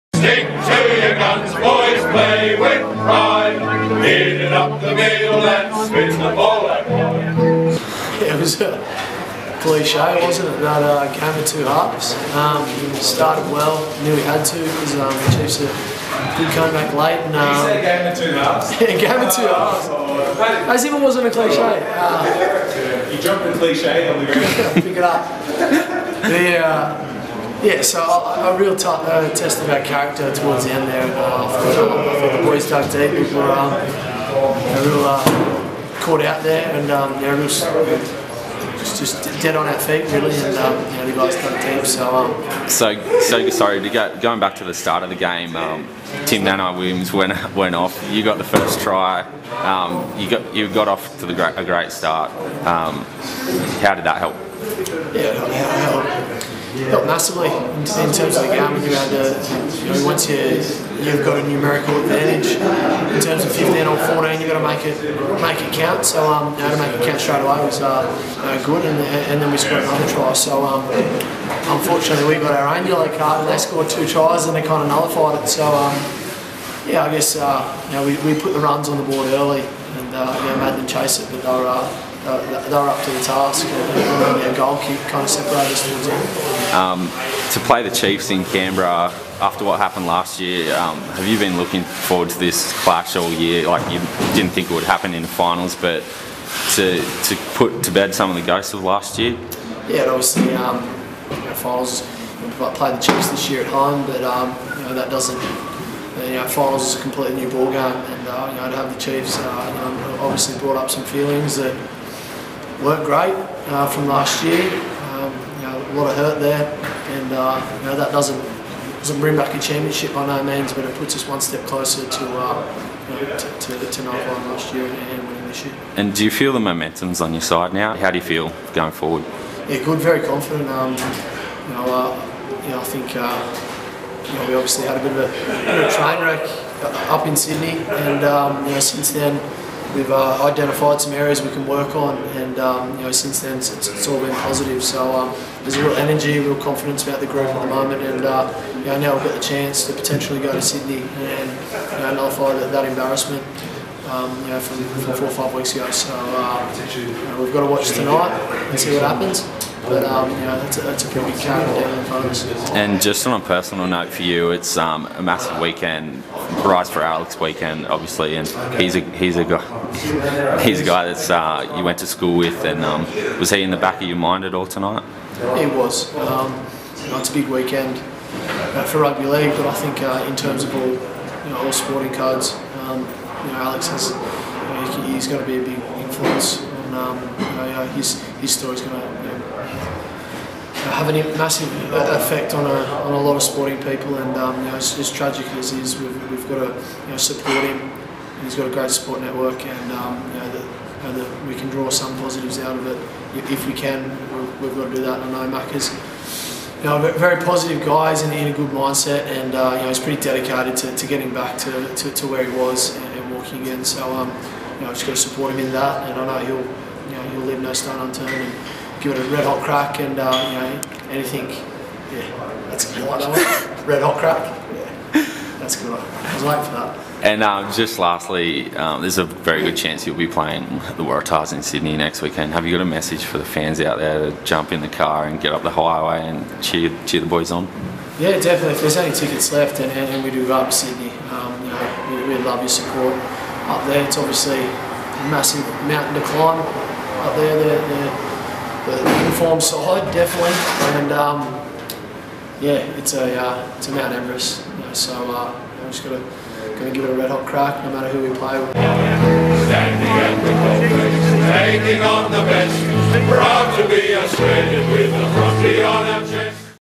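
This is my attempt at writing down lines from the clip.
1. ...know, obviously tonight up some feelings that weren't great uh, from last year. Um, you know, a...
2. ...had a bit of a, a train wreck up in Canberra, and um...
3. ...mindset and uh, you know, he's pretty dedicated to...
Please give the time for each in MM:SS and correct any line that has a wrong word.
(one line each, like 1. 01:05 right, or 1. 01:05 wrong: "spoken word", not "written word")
1. 01:49 wrong: "brought", not "tonight"
2. 02:14 wrong: "Sydney", not "Canberra"
3. 03:28 right.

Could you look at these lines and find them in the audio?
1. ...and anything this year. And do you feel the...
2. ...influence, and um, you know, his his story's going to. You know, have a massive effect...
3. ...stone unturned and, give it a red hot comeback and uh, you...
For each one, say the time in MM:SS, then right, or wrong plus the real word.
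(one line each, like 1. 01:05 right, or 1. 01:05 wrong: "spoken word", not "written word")
1. 02:04 wrong: "winning", not "anything"
2. 03:05 right
3. 03:37 wrong: "crack", not "comeback".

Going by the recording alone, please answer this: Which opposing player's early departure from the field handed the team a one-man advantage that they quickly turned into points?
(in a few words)
Tim Nanai Williams.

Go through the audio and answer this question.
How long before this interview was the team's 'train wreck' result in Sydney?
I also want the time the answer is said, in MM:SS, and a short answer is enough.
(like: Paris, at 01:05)
4 or 5 weeks ago, at 02:35.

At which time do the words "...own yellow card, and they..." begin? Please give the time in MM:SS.
01:12.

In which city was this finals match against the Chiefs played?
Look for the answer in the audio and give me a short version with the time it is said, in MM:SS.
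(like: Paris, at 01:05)
Canberra, at 01:28.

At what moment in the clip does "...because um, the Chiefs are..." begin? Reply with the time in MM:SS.
00:14.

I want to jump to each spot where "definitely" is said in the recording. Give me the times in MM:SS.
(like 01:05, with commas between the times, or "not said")
03:58, 04:10.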